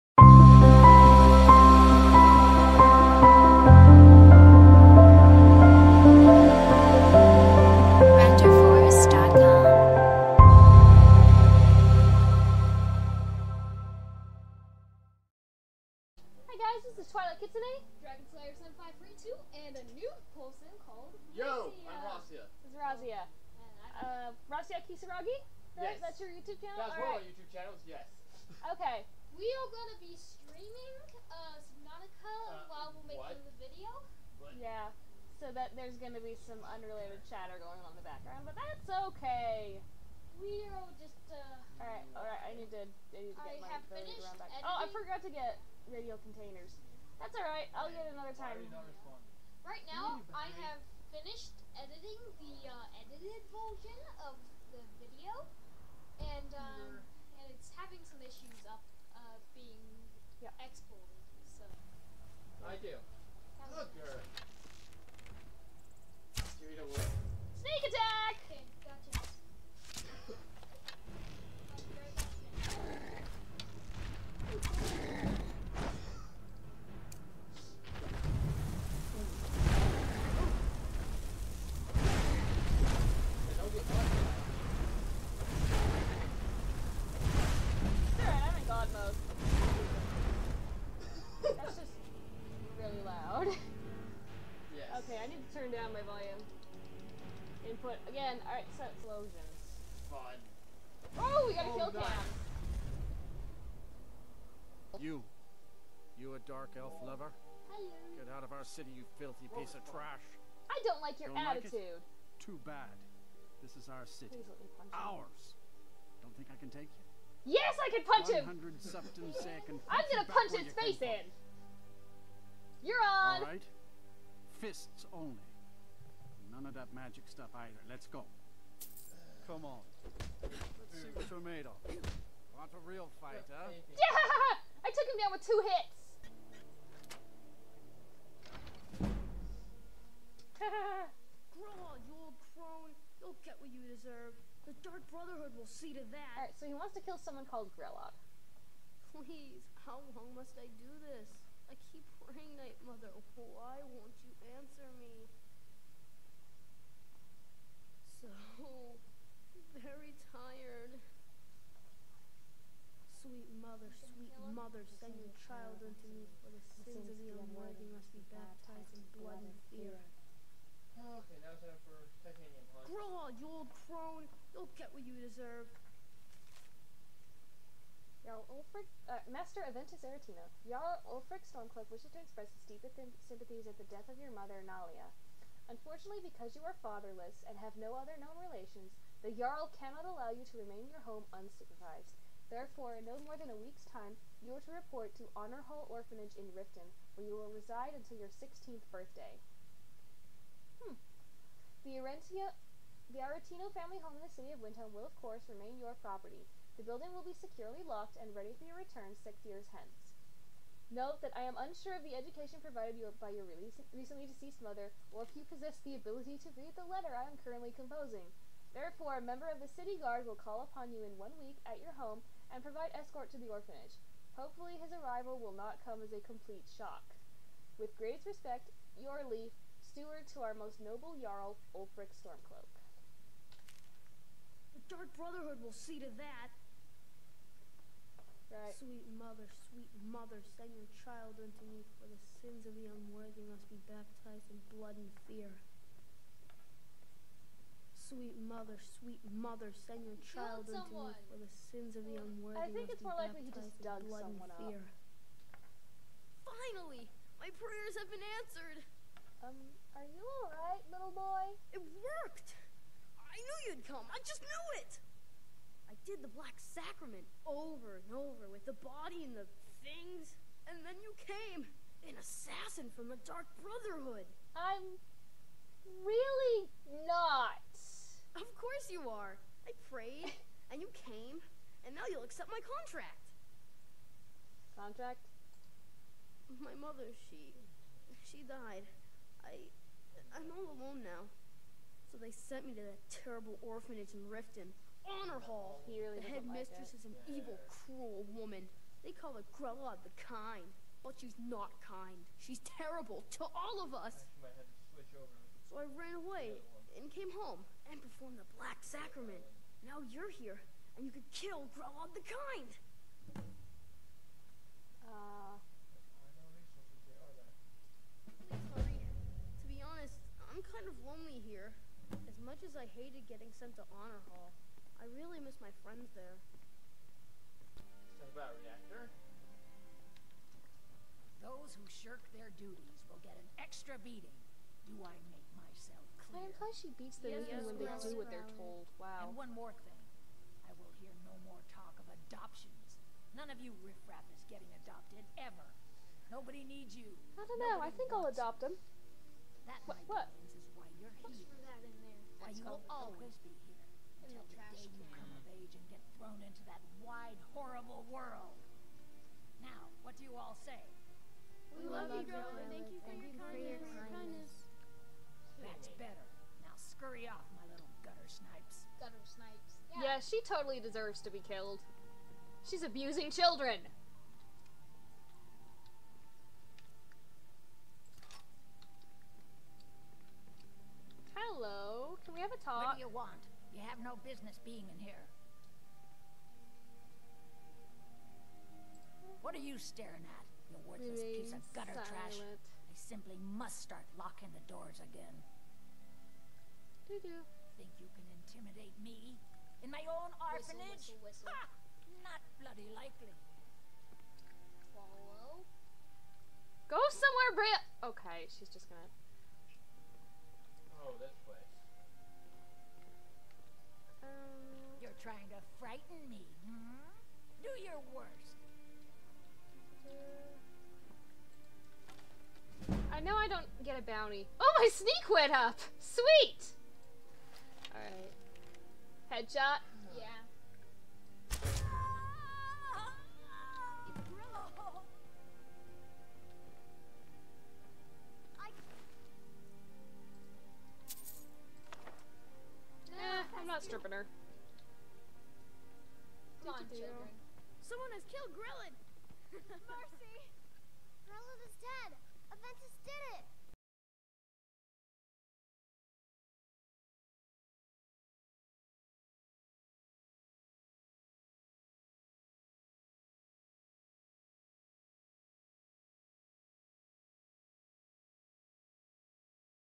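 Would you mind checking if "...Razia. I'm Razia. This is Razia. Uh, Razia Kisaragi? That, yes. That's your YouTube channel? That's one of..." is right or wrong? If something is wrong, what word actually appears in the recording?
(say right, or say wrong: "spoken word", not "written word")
right.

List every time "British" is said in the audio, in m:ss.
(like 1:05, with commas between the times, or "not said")
not said.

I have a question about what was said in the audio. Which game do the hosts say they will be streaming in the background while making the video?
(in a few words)
Subnautica.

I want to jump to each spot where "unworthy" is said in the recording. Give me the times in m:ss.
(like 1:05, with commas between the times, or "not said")
2:47, 4:02, 4:12.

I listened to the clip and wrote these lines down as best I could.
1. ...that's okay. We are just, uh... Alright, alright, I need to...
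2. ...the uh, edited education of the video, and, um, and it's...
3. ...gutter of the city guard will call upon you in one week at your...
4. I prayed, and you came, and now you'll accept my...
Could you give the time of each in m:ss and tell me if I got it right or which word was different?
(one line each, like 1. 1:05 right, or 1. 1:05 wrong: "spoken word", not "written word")
1. 0:38 right
2. 0:52 wrong: "version", not "education"
3. 3:39 wrong: "member", not "gutter"
4. 4:39 right.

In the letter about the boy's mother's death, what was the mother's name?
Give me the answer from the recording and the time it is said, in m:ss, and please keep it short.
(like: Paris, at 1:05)
Nalia, at 3:04.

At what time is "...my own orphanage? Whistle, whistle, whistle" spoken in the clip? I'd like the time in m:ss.
6:39.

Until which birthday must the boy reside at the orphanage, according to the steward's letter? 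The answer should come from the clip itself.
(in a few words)
16th.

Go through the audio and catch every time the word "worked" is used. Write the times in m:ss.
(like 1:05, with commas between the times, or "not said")
4:22.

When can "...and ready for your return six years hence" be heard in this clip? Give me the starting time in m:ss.
3:28.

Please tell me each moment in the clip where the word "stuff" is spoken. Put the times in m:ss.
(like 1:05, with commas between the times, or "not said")
2:07.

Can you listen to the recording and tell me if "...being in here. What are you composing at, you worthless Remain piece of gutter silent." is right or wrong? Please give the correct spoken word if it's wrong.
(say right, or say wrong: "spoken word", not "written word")
wrong: "staring", not "composing".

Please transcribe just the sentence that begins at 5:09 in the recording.
Now you're here, and you could kill Grelod the Kind.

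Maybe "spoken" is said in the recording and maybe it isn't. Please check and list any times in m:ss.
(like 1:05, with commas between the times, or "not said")
not said.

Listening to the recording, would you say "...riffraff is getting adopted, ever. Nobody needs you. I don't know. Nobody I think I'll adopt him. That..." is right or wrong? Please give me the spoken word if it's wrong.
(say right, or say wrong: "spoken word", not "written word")
right.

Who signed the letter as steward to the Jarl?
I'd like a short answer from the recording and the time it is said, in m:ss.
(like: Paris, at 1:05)
Jorleif, at 3:48.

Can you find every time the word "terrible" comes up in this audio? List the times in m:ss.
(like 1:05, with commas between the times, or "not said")
4:53, 5:02.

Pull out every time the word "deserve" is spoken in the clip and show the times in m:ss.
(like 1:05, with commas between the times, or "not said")
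2:23, 2:55, 6:10.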